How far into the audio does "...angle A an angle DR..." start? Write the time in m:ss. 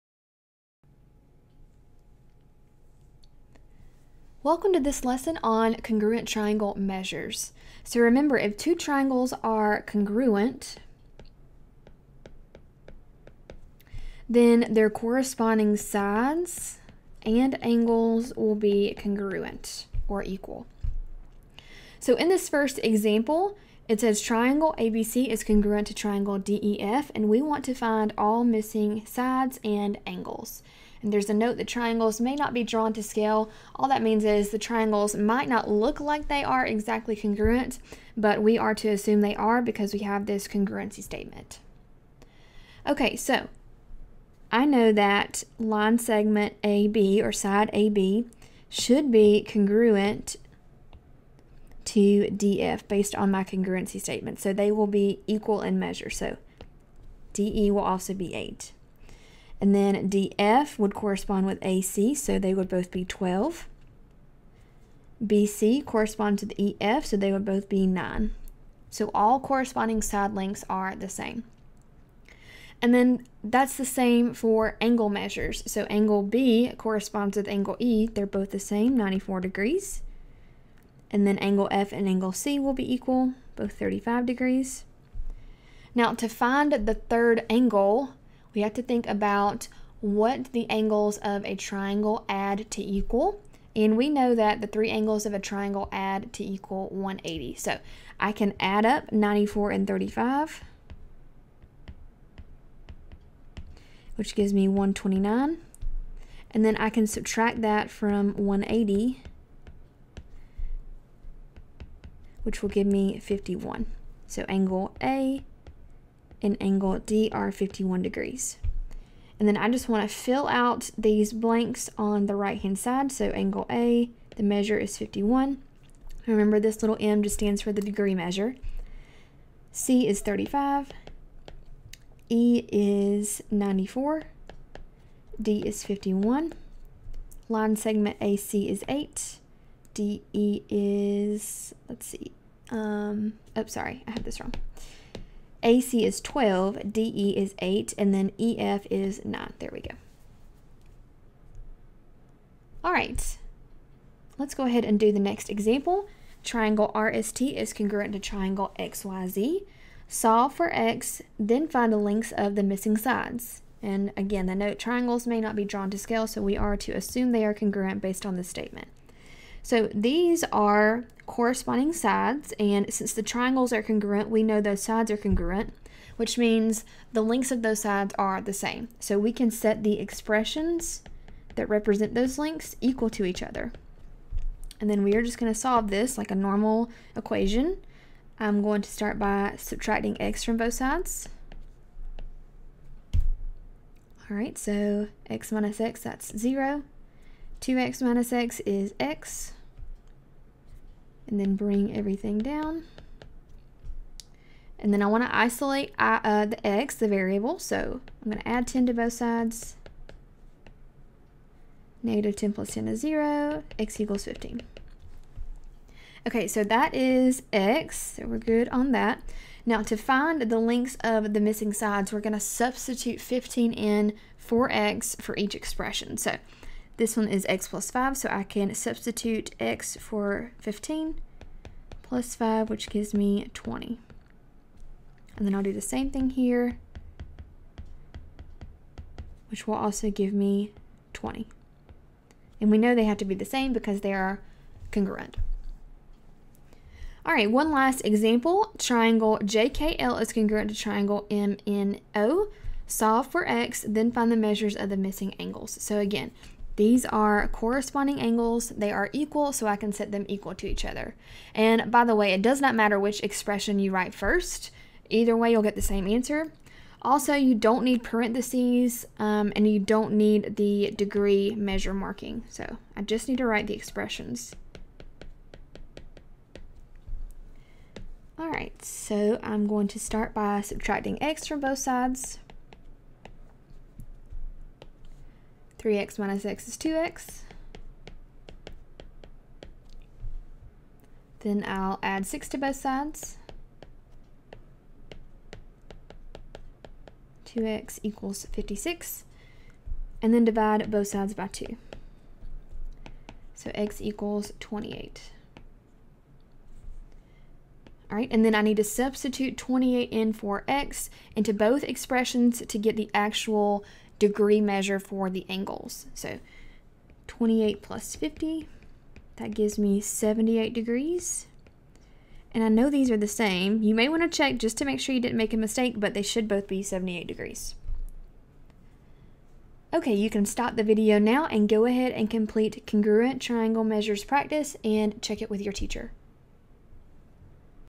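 1:54.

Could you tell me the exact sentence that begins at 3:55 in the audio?
And then I'll do the same thing here, which will also give me 20.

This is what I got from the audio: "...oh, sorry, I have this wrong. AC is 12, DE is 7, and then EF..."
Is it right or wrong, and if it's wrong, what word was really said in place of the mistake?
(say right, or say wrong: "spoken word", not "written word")
wrong: "8", not "7".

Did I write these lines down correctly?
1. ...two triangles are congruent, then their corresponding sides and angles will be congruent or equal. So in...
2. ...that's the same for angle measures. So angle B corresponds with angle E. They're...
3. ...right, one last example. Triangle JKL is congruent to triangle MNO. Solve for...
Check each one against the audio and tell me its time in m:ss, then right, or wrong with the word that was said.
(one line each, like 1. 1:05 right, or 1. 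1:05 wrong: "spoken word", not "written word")
1. 0:08 right
2. 1:13 right
3. 4:07 right.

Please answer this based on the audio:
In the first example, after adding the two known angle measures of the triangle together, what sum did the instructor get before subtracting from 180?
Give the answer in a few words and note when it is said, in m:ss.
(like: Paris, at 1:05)
129, at 1:44.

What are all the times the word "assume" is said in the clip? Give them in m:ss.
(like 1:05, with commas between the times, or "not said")
0:38, 2:46.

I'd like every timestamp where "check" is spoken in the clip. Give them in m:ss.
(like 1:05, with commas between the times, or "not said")
5:24, 5:35.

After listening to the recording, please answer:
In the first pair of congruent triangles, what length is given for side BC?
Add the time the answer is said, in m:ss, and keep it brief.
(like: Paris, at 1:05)
9, at 1:05.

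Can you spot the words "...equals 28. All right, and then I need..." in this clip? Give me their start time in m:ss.
5:04.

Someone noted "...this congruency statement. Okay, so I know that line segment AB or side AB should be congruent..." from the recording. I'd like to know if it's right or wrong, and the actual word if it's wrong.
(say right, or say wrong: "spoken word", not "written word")
right.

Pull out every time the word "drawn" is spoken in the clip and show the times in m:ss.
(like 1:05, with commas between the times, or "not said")
0:32, 2:45.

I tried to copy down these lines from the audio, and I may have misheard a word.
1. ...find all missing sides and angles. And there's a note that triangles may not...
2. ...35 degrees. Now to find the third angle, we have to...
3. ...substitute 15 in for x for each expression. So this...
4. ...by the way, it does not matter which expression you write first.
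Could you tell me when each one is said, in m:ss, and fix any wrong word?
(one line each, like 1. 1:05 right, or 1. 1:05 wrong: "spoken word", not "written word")
1. 0:27 right
2. 1:23 right
3. 3:42 right
4. 4:21 right.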